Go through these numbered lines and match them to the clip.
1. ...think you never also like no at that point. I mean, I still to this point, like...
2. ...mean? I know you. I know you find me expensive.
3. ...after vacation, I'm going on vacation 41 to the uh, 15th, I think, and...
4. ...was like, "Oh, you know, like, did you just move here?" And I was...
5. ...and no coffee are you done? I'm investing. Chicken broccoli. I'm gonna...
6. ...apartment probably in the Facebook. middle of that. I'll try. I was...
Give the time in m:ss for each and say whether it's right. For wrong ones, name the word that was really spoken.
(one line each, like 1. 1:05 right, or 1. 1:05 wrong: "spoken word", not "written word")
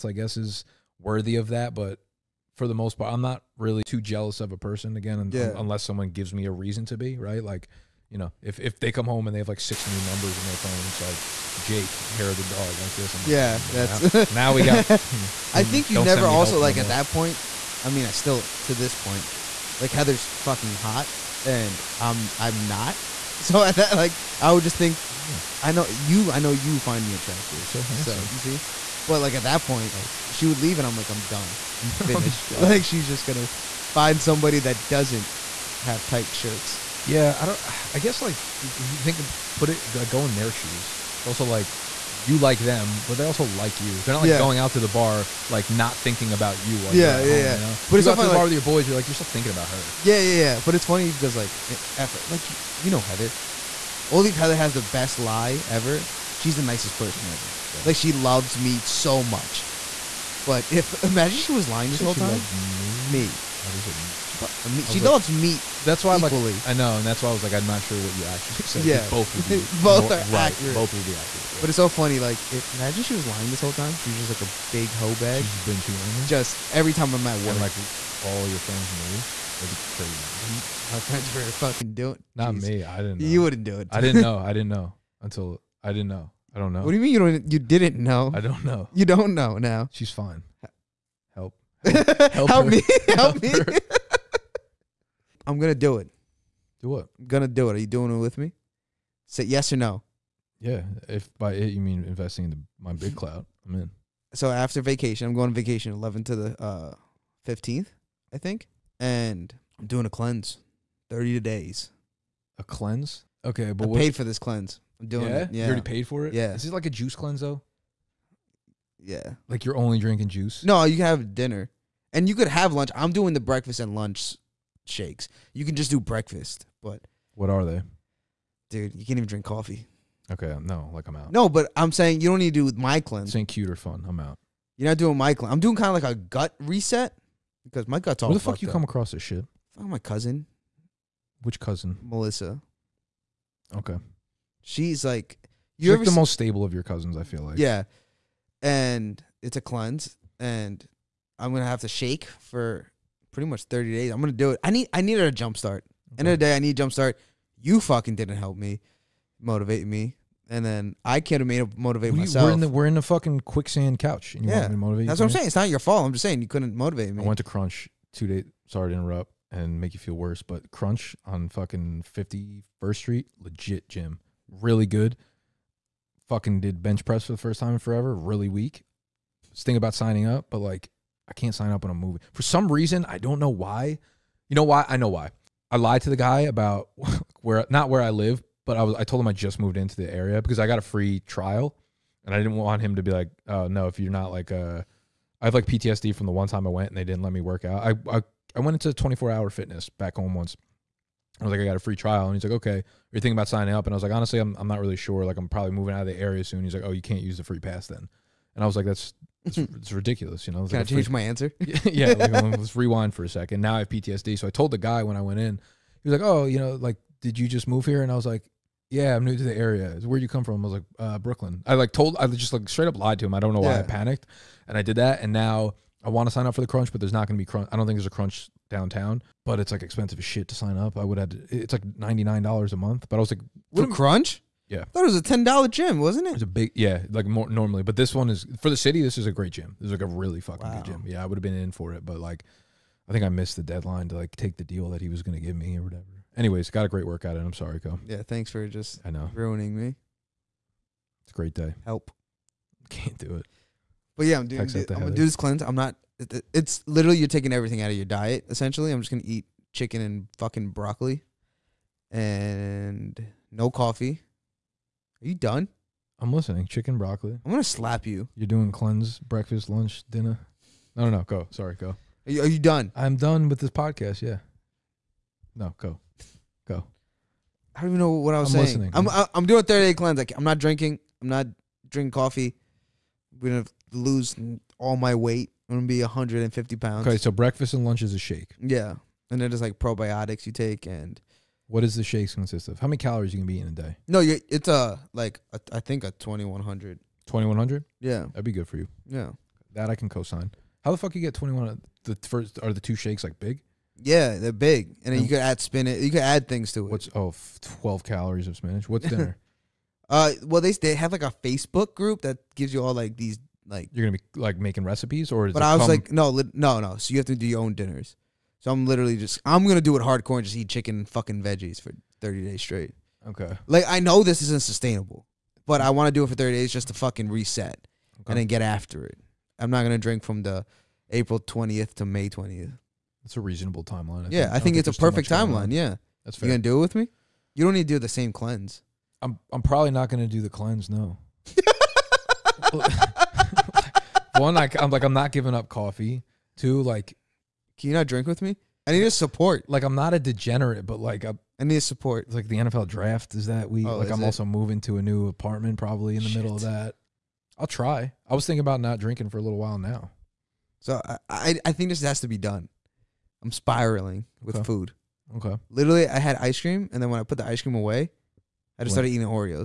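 1. 0:15 right
2. 0:25 wrong: "attractive", not "expensive"
3. 1:44 wrong: "11", not "41"
4. 3:36 right
5. 4:22 wrong: "listening", not "investing"
6. 5:55 wrong: "Shit", not "Facebook".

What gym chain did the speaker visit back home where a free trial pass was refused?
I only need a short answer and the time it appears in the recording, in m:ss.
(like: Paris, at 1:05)
24-hour fitness, at 3:19.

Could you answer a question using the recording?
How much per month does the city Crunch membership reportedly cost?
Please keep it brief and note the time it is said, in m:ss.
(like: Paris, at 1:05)
$99, at 3:51.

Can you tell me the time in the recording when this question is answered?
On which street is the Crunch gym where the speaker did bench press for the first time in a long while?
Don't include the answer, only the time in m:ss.
2:52.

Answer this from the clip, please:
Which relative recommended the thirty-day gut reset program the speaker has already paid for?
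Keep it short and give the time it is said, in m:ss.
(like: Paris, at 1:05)
Melissa, at 2:22.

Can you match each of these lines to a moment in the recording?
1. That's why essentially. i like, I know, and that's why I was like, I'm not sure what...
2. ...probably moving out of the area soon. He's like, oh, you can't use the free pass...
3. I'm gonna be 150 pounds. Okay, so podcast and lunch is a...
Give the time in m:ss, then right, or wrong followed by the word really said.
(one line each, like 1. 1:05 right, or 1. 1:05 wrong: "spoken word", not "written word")
1. 1:05 wrong: "equally", not "essentially"
2. 3:25 right
3. 4:45 wrong: "breakfast", not "podcast".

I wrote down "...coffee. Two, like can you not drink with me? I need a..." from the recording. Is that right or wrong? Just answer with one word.
right.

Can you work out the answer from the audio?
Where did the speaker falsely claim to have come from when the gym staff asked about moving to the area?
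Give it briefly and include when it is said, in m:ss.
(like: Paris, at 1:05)
Brooklyn, at 3:41.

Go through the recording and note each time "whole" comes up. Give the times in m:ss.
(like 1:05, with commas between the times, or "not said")
1:02, 1:13.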